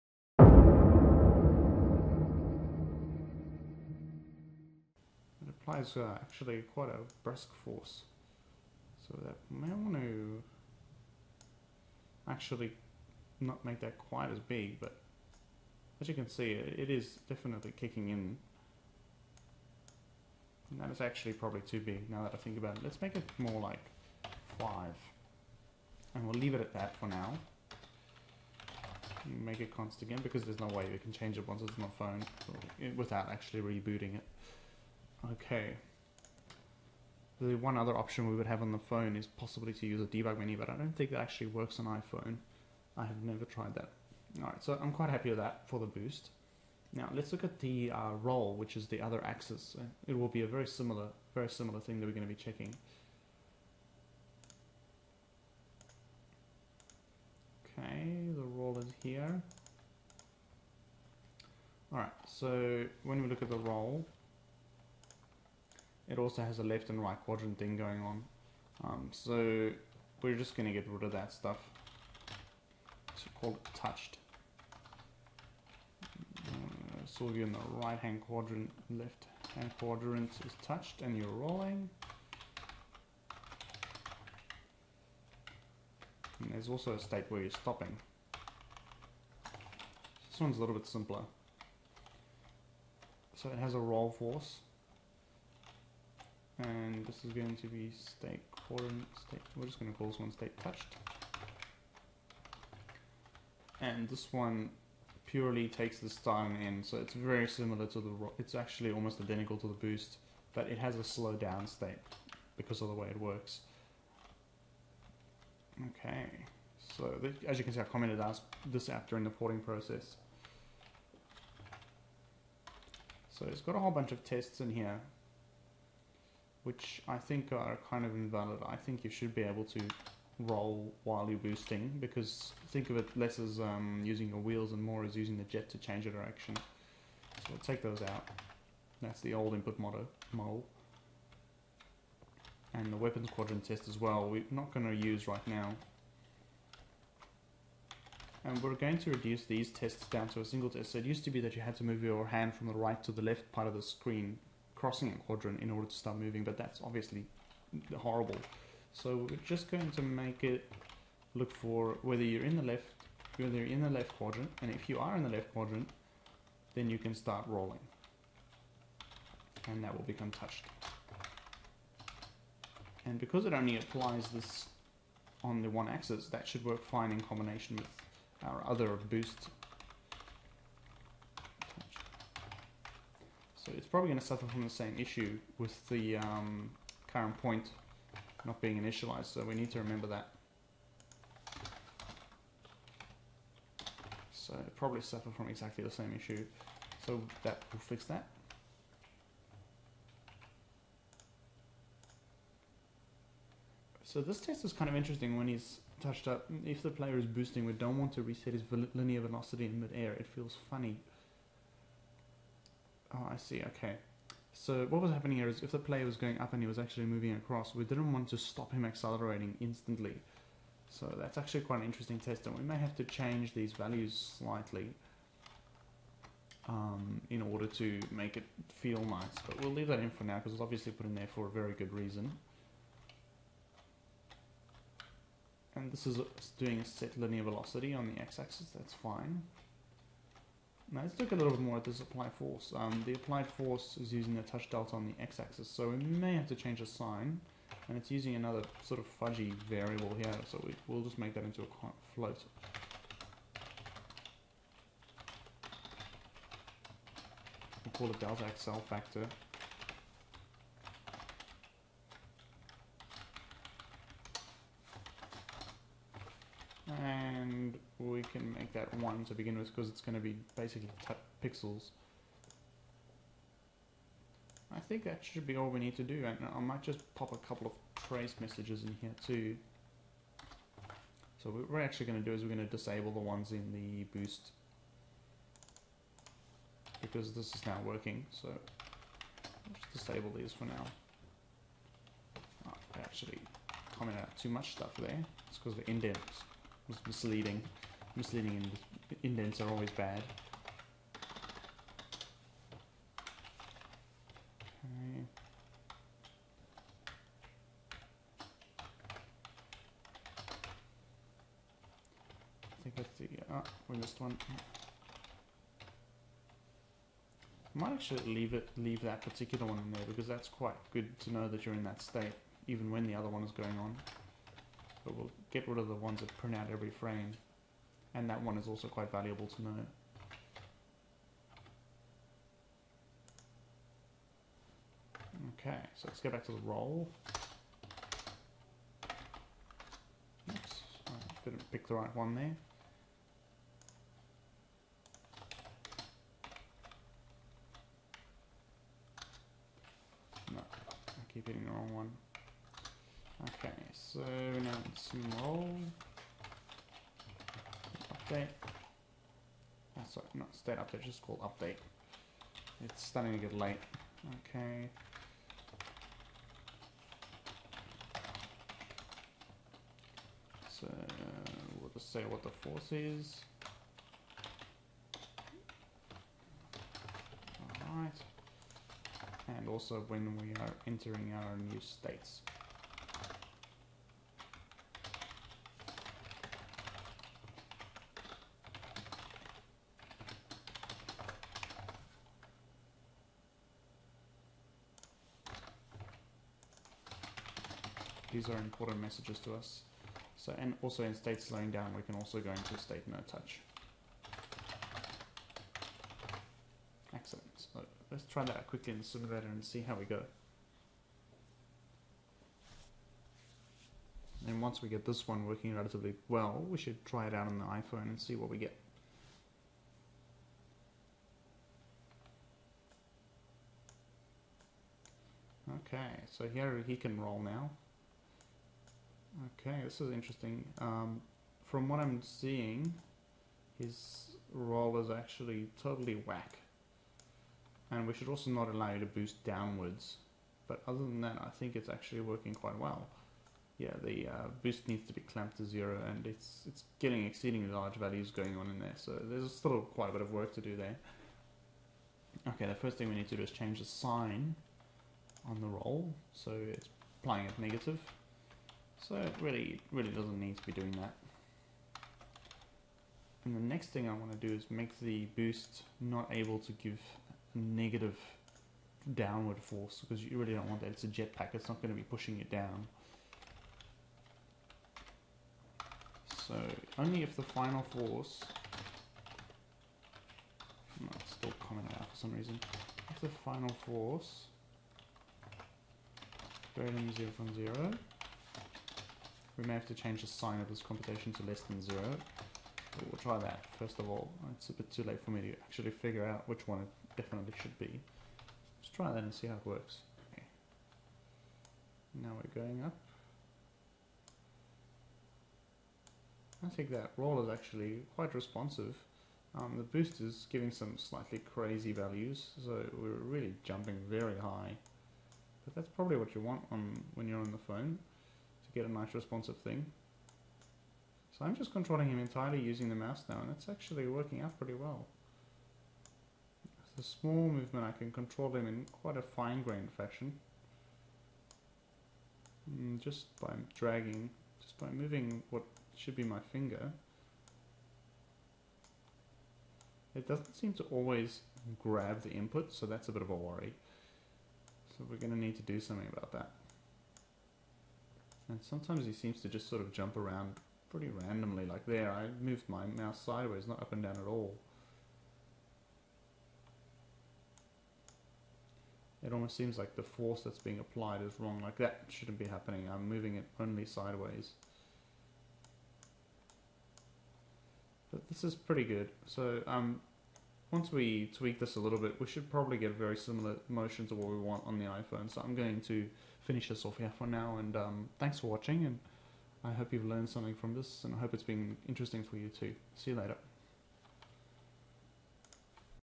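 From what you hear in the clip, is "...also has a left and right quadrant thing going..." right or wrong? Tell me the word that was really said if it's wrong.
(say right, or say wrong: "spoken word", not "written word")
right.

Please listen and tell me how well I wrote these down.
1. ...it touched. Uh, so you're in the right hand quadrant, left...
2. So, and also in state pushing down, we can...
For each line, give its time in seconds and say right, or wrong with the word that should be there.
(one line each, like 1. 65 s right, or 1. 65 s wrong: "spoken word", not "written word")
1. 73 s right
2. 400 s wrong: "slowing", not "pushing".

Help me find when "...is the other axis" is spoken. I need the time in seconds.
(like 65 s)
48 s.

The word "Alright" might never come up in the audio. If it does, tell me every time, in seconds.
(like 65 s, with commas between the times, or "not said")
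44 s, 61 s, 377 s.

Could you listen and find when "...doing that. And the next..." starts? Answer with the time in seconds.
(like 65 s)
460 s.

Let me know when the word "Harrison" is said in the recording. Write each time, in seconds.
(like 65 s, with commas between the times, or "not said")
not said.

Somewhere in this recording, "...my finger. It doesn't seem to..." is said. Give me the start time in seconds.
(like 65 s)
536 s.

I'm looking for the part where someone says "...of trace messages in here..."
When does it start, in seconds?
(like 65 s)
277 s.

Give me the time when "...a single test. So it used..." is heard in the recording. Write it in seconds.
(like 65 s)
150 s.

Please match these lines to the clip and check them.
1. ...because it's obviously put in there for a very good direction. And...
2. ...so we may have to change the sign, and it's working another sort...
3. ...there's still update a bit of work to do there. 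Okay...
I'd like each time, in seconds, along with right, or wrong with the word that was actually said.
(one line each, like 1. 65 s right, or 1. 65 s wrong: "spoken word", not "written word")
1. 230 s wrong: "reason", not "direction"
2. 245 s wrong: "using", not "working"
3. 449 s wrong: "quite", not "update".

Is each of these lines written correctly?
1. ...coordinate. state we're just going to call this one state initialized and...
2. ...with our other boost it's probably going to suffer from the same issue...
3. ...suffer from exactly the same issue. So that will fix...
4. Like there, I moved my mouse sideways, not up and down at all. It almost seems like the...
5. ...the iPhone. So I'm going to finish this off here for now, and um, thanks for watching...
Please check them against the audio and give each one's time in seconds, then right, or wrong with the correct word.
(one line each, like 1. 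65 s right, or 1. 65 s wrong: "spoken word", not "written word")
1. 98 s wrong: "touched", not "initialized"
2. 177 s right
3. 195 s right
4. 551 s right
5. 574 s right.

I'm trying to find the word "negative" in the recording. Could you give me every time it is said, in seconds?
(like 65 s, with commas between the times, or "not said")
457 s, 467 s.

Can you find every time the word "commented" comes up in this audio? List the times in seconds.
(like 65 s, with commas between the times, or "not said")
117 s, 293 s.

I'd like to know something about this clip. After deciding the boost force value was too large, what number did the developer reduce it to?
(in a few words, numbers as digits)
5.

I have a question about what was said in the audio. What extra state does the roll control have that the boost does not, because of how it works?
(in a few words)
slow down state.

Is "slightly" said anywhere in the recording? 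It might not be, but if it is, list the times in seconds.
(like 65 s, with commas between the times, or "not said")
224 s, 510 s.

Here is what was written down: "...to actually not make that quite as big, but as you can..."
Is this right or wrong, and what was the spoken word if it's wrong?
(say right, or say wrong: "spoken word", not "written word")
right.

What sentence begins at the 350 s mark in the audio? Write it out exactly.
No, I keep hitting the wrong one.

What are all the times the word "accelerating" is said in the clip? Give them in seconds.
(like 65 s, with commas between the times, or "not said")
218 s.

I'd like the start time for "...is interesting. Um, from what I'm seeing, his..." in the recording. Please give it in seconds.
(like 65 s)
430 s.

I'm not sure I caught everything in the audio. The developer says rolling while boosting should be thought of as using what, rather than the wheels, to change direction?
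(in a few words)
the jet.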